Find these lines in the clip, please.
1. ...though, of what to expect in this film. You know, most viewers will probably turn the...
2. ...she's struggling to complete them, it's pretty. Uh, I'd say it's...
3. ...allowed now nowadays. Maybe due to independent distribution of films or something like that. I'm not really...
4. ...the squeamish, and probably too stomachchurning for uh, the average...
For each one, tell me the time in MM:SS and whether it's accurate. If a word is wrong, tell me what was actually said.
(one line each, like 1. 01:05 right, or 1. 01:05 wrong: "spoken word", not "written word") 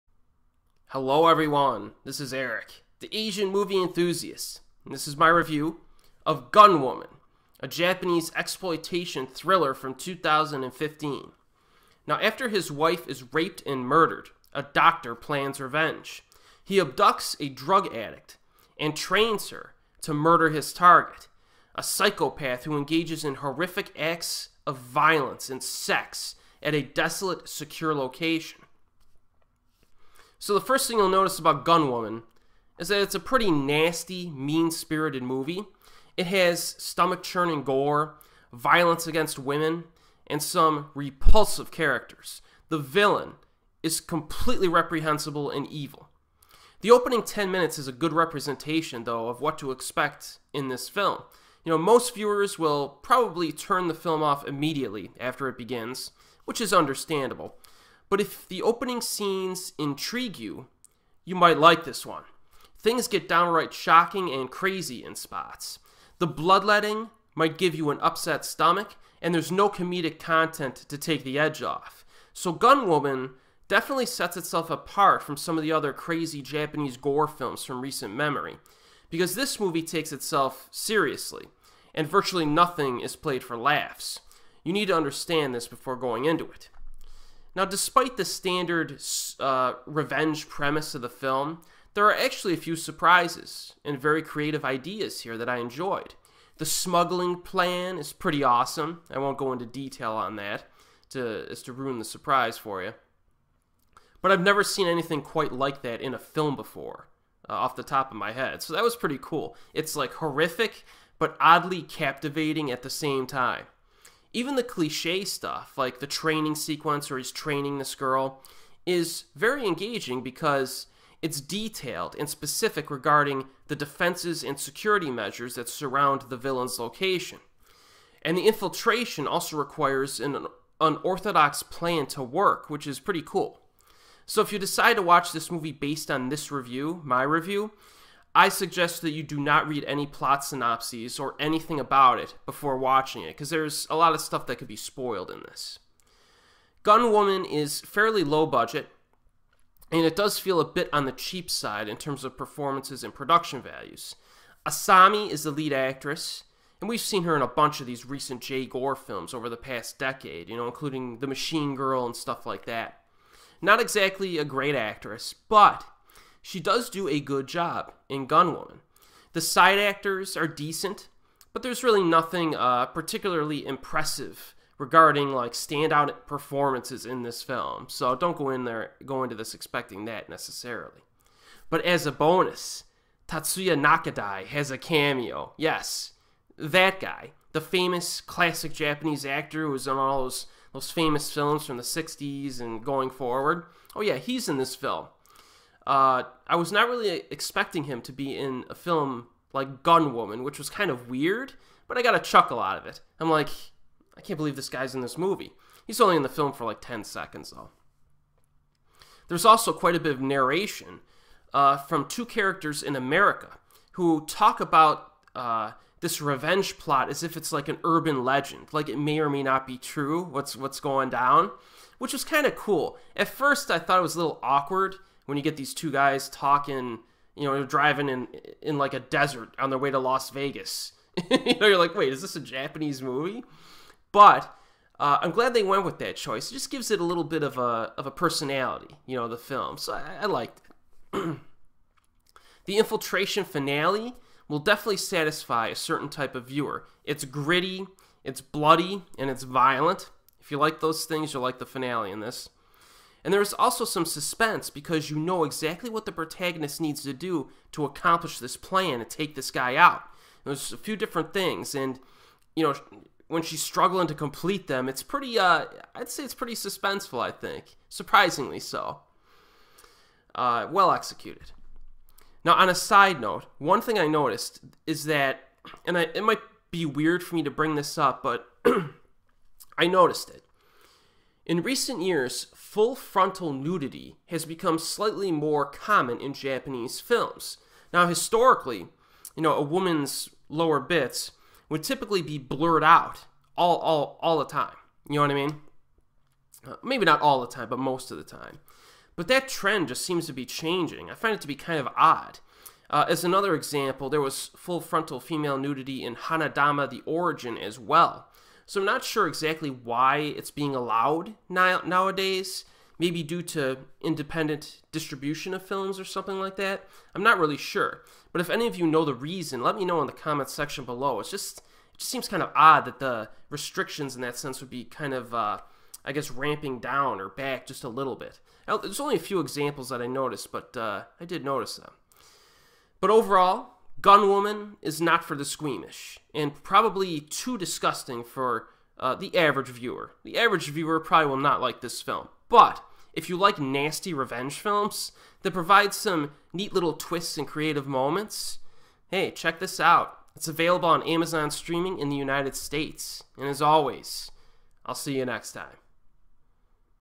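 1. 00:49 right
2. 04:23 right
3. 05:10 right
4. 05:35 wrong: "disgusting", not "stomachchurning".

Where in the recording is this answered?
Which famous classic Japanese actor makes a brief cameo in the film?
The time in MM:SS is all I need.
03:03.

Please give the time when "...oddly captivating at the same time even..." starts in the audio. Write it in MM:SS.
01:51.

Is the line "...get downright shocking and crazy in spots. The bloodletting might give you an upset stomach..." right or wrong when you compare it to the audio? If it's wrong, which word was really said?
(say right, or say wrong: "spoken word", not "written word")
right.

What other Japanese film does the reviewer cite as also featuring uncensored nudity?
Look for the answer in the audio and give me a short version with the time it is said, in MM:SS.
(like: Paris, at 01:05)
Hanadama the Origin, at 05:06.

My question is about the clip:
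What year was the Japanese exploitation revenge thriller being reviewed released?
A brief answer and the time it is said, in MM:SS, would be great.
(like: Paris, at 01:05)
2015, at 00:09.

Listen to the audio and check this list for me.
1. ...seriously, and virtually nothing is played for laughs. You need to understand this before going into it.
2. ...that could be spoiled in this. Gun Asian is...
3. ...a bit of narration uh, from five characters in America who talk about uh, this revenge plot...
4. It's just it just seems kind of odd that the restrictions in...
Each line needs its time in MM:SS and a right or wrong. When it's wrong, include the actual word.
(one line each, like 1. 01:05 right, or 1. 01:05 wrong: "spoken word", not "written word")
1. 01:20 right
2. 02:24 wrong: "Woman", not "Asian"
3. 03:29 wrong: "two", not "five"
4. 05:21 right.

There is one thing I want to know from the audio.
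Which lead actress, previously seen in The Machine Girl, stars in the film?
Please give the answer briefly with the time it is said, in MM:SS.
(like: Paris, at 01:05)
Asami, at 02:34.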